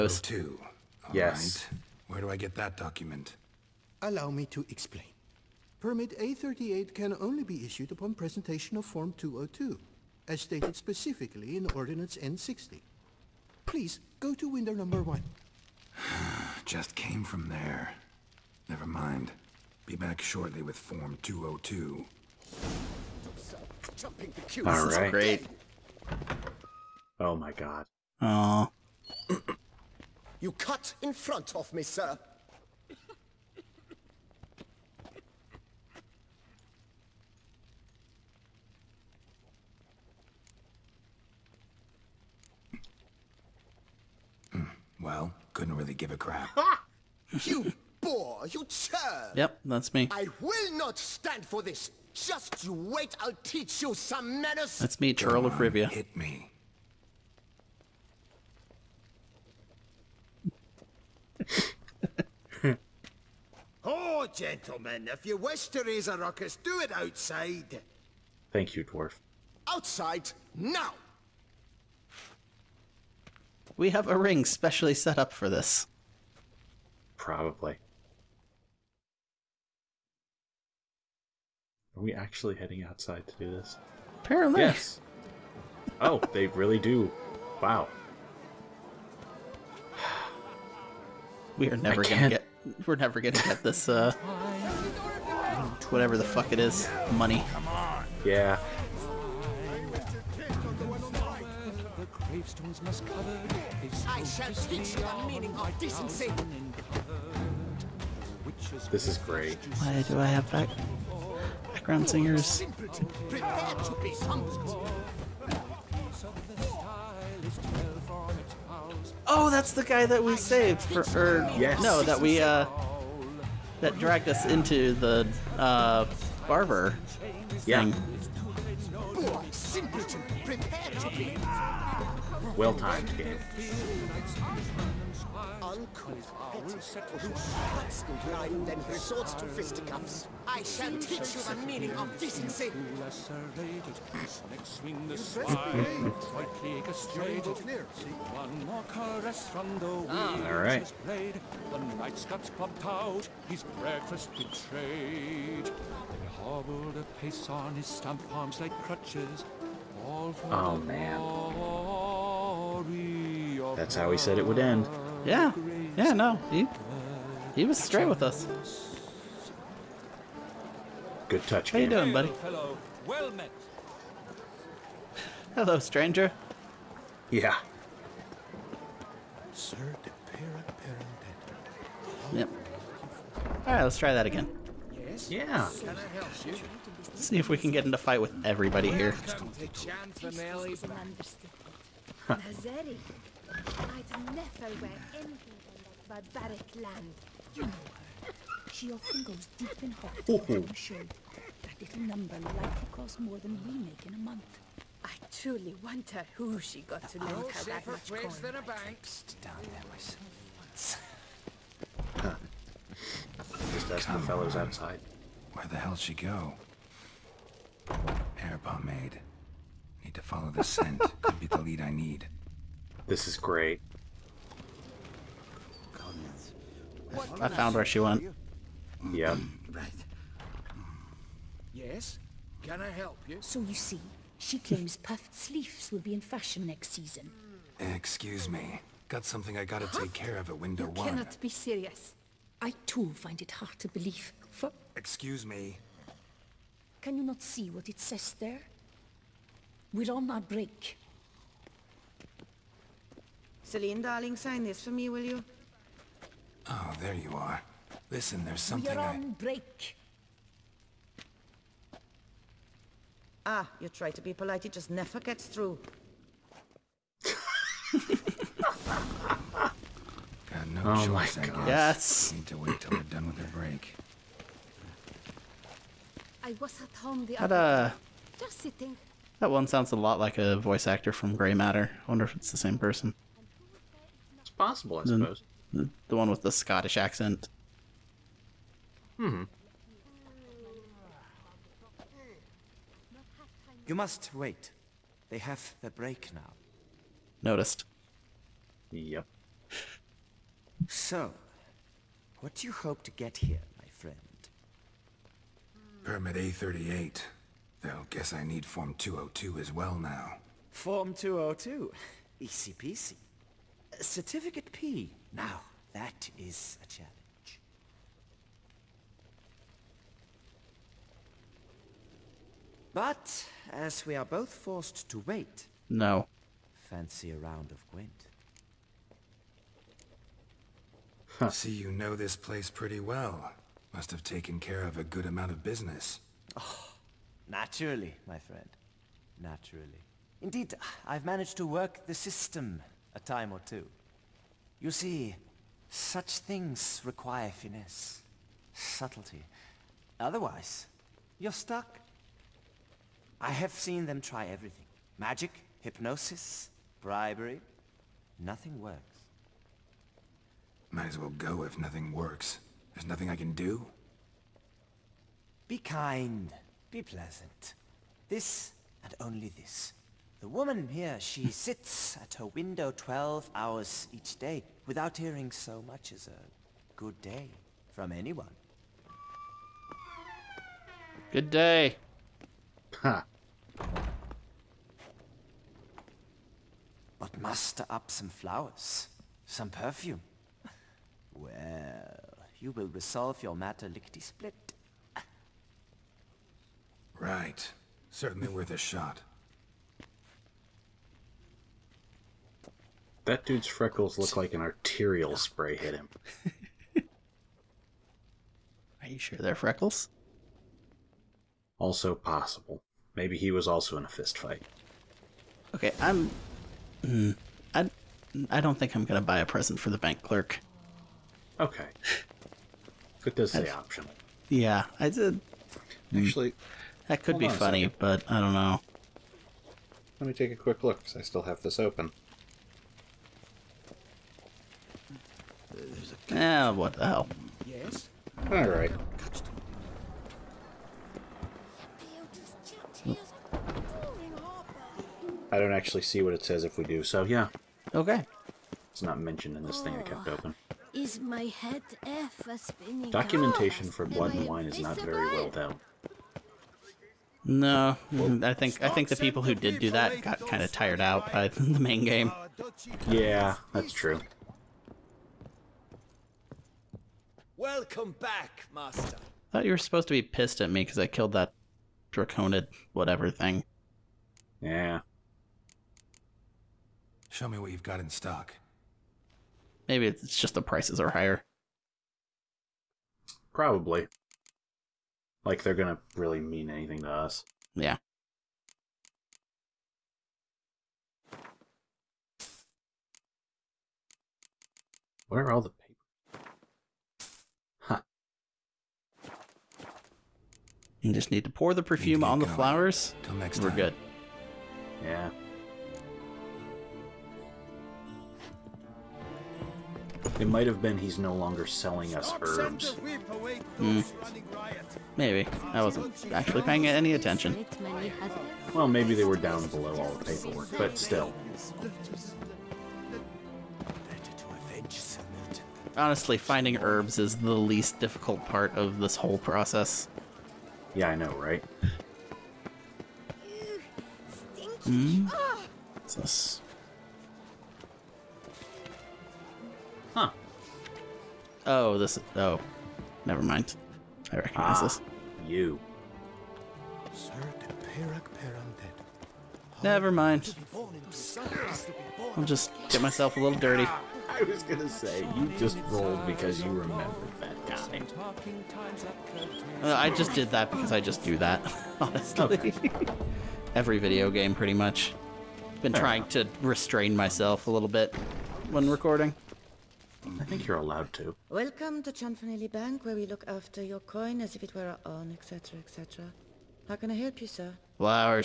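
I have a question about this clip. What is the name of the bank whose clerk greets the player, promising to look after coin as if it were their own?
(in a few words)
Cianfanelli Bank.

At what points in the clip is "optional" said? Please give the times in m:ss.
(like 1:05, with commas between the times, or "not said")
7:03.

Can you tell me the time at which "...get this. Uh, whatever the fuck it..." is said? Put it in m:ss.
1:33.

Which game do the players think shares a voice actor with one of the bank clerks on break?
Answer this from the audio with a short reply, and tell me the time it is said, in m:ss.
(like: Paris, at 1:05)
Grey Matter, at 4:41.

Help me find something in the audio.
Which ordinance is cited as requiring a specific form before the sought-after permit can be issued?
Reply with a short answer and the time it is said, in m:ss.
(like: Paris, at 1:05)
Ordinance N60, at 0:11.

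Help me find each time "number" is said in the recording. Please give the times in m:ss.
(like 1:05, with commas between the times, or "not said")
0:14, 3:22.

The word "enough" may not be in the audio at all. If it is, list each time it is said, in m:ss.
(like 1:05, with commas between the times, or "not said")
9:26.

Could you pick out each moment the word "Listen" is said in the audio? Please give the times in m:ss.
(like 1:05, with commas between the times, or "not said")
4:18.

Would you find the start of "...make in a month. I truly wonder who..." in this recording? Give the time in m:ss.
3:23.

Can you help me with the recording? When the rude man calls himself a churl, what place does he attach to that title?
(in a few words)
Rivia.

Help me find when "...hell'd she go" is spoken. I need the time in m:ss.
3:35.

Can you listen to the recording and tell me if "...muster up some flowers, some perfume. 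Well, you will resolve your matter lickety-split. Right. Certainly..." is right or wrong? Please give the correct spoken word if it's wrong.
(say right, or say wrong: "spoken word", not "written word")
right.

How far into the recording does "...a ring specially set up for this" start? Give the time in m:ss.
1:14.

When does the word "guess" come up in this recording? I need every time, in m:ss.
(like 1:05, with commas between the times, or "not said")
4:31, 5:08.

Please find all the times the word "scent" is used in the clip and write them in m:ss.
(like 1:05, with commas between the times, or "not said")
3:40.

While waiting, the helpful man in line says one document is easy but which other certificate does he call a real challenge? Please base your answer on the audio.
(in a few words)
Certificate P.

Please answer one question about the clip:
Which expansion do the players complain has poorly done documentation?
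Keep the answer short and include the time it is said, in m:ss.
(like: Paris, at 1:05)
Blood and Wine, at 7:34.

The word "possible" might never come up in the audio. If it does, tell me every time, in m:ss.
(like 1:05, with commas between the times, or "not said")
4:44, 6:52.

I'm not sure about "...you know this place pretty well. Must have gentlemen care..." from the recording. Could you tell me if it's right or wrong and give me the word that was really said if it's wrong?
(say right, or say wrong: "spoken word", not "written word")
wrong: "taken", not "gentlemen".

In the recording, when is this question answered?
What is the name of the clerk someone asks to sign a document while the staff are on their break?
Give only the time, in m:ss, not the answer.
4:13.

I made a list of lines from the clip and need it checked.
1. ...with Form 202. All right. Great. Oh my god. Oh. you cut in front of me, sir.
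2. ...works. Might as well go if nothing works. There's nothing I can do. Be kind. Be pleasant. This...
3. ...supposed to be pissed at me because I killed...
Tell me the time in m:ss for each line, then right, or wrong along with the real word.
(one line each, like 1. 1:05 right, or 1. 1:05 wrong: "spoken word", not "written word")
1. 0:20 right
2. 5:58 right
3. 7:49 right.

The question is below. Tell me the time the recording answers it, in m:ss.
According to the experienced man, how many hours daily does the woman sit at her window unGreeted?
6:12.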